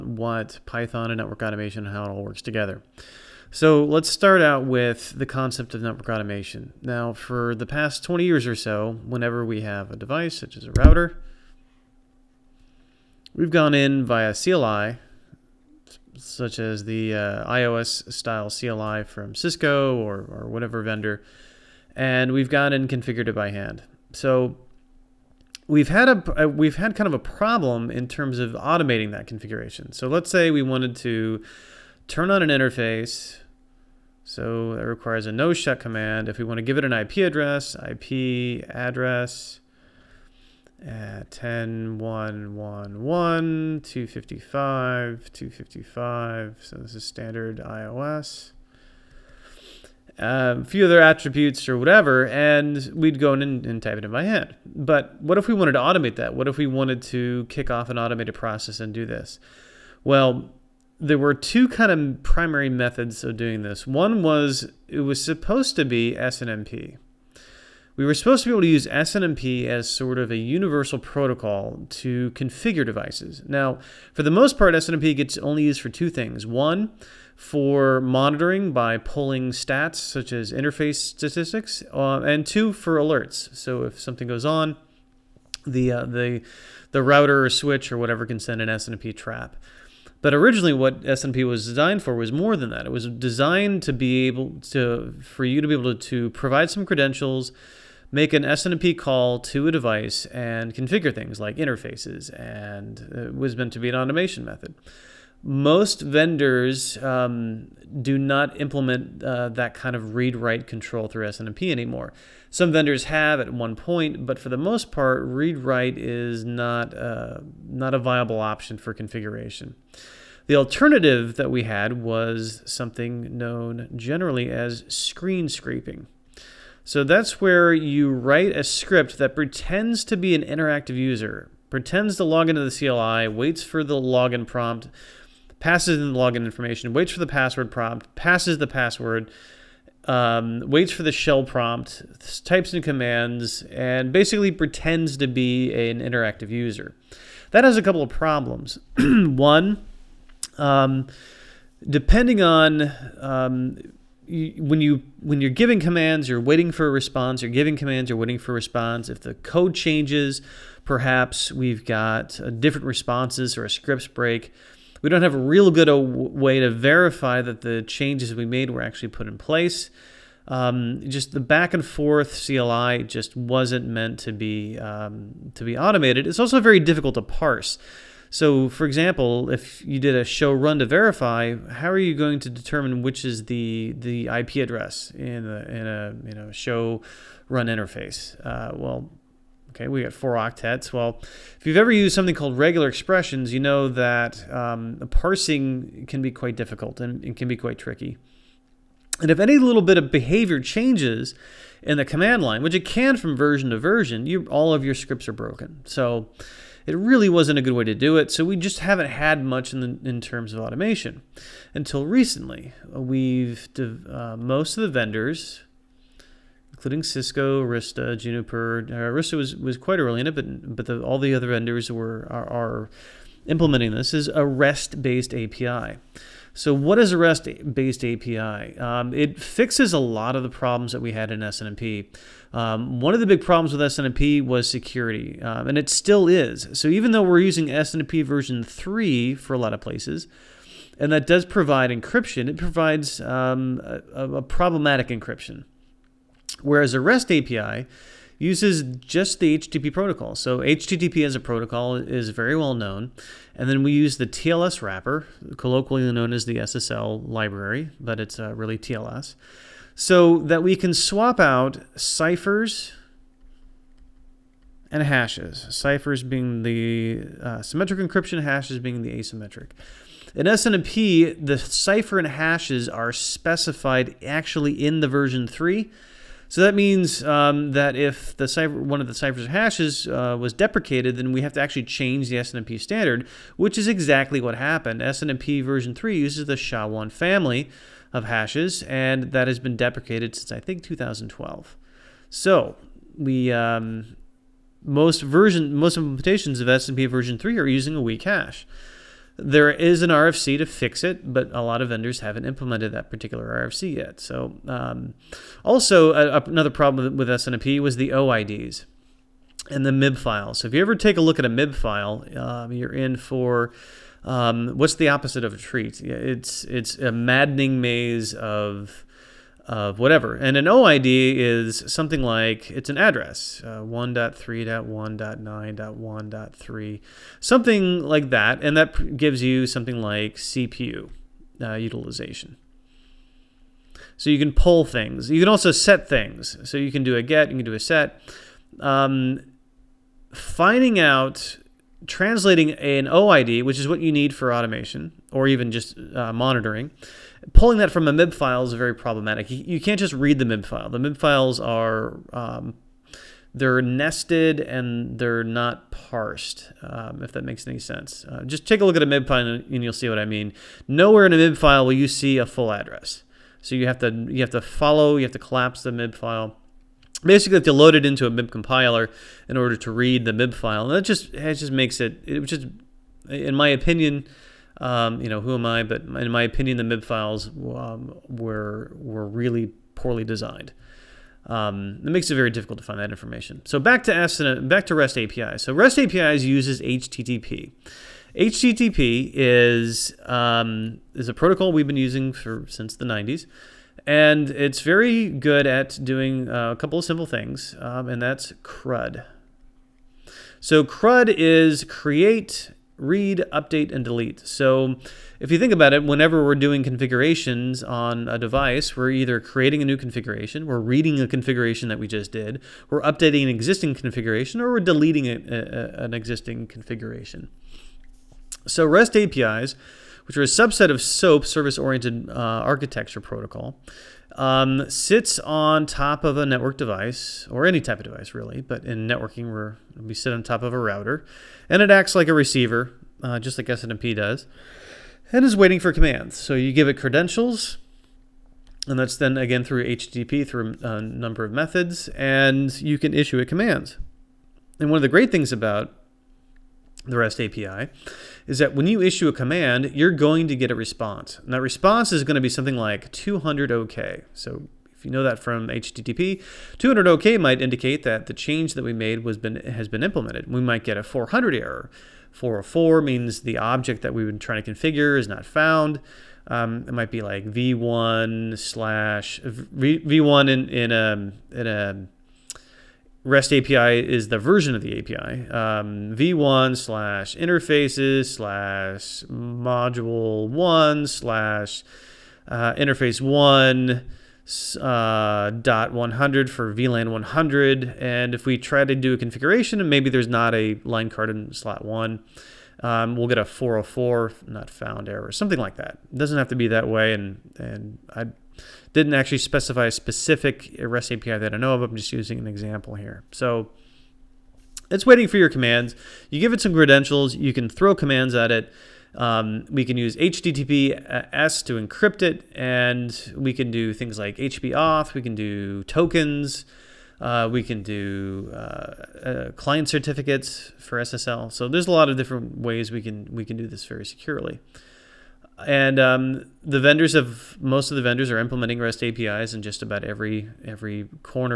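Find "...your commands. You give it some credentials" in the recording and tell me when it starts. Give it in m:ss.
8:25.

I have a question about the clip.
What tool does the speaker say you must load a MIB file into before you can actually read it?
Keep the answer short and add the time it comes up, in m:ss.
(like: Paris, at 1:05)
MIB compiler, at 6:08.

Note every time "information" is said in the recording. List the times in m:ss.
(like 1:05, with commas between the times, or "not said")
2:16, 6:23.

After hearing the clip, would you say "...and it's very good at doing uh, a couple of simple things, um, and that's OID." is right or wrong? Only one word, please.
wrong.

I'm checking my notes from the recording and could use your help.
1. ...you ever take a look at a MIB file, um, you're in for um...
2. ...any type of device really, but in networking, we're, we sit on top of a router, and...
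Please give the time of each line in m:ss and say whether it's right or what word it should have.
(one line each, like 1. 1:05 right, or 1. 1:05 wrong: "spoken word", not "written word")
1. 5:10 right
2. 7:07 right.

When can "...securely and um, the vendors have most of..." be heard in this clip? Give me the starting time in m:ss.
8:44.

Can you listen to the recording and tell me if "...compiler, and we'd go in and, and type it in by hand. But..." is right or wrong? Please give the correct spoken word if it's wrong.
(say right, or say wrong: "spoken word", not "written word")
wrong: "whatever", not "compiler".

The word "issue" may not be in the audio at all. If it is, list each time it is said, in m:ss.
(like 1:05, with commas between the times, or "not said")
7:23, 7:29.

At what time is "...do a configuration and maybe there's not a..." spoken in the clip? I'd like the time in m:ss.
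8:08.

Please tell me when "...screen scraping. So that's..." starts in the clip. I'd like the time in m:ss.
2:04.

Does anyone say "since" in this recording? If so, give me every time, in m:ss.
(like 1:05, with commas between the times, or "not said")
4:50, 6:32.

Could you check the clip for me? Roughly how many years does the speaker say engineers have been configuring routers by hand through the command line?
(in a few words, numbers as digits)
20 years.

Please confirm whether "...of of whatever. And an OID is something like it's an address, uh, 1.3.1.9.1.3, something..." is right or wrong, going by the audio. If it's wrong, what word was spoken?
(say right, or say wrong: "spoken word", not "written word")
right.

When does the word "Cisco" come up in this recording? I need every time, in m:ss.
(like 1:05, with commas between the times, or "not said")
0:19, 3:37.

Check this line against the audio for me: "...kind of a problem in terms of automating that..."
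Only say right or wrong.
right.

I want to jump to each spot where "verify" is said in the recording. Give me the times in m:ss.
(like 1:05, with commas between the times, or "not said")
2:46, 3:00.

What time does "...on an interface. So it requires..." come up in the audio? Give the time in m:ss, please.
0:32.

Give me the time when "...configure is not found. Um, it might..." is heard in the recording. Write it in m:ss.
7:44.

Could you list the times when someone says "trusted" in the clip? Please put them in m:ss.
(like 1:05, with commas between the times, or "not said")
not said.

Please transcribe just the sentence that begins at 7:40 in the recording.
We might get a 400 error.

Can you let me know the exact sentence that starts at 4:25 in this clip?
Ciphers being the uh, symmetric encryption, hashes being the asymmetric.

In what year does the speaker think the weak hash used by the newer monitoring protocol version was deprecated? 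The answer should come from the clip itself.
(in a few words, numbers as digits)
2012.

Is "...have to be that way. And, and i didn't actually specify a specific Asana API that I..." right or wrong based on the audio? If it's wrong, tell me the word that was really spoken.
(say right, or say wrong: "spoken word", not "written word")
wrong: "REST", not "Asana".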